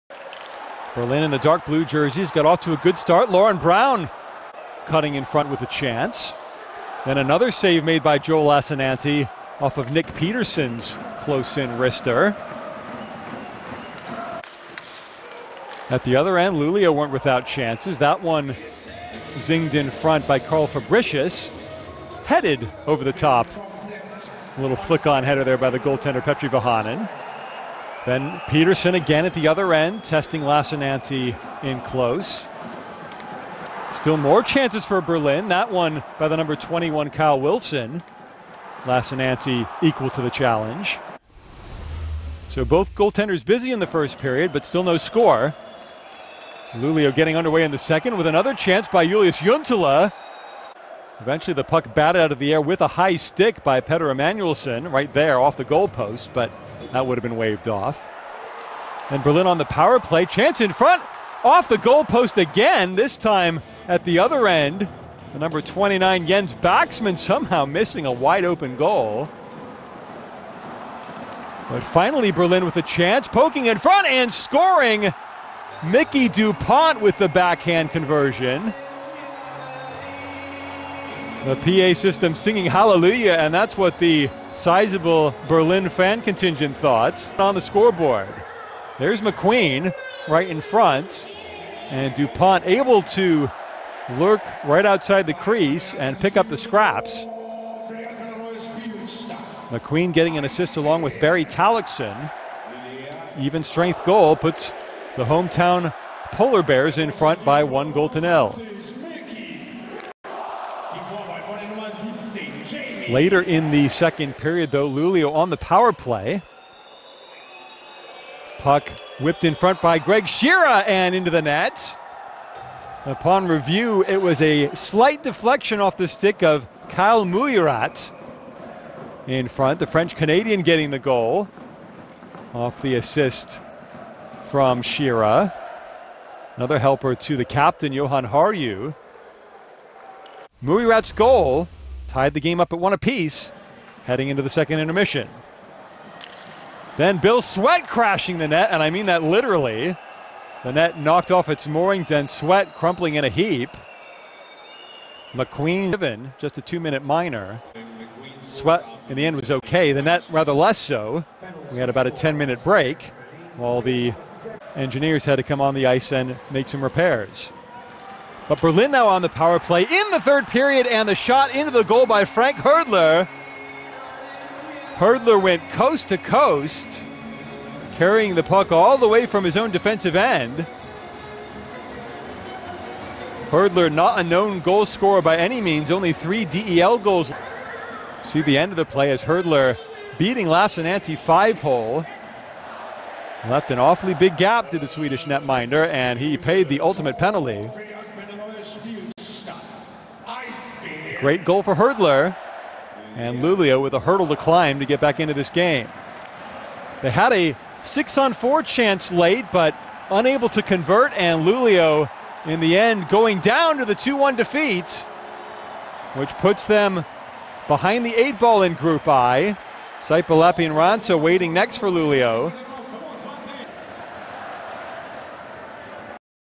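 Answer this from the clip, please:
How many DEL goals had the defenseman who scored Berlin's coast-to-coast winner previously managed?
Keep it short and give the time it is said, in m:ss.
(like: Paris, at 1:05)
3, at 3:06.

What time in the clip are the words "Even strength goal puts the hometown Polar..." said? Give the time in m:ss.
1:43.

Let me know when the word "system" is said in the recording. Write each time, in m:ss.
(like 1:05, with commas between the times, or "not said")
1:21.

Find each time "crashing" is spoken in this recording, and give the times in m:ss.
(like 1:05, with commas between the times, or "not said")
2:27.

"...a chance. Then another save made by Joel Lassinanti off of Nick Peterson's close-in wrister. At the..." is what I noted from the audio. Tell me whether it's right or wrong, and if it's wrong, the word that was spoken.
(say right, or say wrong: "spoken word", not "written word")
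right.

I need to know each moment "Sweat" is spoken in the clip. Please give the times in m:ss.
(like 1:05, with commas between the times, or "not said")
2:27, 2:32, 2:38.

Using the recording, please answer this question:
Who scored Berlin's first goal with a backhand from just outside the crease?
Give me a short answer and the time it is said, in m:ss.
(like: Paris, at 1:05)
Micki DuPont, at 1:15.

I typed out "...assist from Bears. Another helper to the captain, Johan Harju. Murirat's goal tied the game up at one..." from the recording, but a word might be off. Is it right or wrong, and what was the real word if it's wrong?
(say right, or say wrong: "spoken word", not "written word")
wrong: "Shearer", not "Bears".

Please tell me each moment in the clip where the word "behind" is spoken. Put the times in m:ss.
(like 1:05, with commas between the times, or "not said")
3:37.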